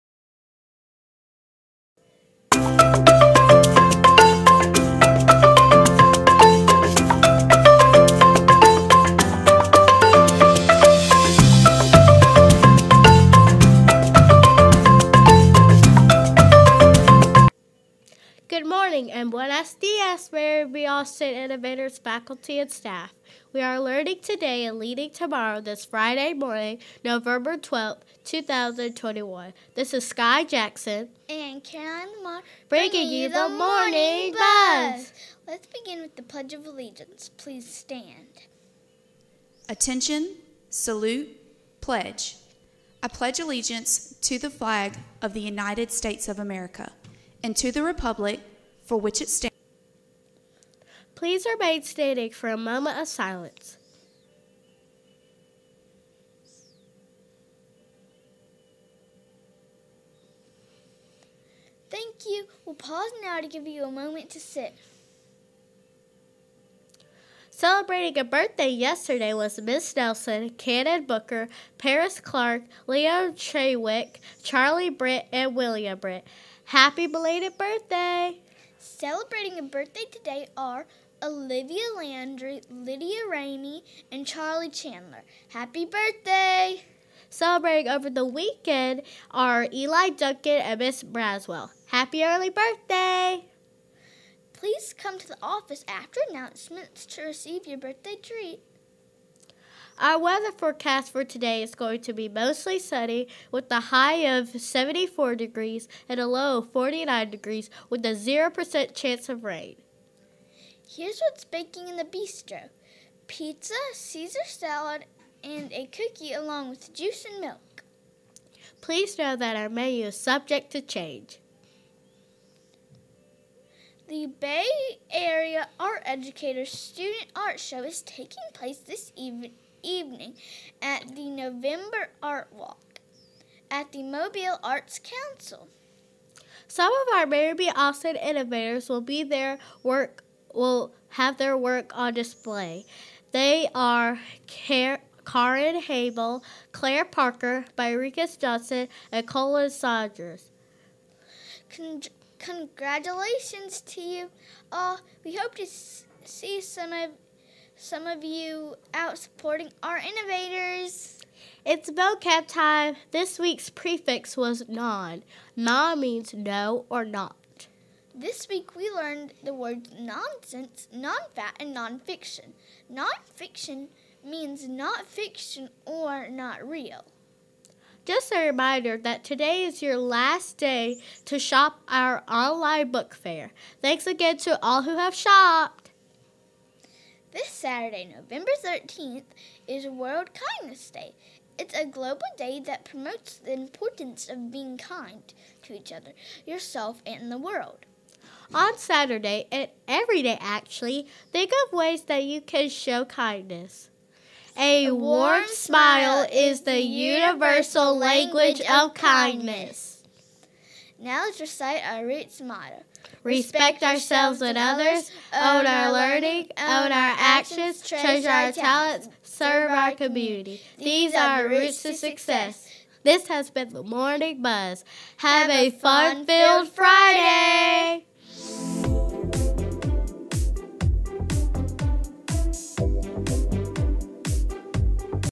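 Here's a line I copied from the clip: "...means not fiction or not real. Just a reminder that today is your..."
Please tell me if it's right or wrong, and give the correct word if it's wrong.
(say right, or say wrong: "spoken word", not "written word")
right.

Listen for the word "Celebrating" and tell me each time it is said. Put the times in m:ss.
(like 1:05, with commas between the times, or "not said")
1:07, 1:18, 1:27.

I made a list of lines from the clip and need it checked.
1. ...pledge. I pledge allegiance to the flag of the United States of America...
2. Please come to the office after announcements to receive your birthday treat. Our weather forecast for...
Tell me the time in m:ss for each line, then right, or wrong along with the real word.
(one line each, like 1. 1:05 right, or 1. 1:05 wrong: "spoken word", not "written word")
1. 0:41 right
2. 1:34 right.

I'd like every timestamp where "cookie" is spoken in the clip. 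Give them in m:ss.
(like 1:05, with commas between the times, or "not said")
1:55.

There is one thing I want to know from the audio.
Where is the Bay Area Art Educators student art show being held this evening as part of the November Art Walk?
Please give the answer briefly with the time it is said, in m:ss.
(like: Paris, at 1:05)
Mobile Arts Council, at 2:14.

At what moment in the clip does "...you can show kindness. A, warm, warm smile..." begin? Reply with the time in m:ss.
3:22.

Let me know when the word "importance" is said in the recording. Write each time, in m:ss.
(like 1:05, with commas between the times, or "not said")
3:13.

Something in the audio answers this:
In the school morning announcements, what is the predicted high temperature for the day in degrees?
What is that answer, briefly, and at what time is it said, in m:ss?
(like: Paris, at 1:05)
74, at 1:44.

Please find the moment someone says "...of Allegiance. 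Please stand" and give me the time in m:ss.
0:36.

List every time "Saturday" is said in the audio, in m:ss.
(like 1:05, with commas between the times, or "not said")
3:07, 3:18.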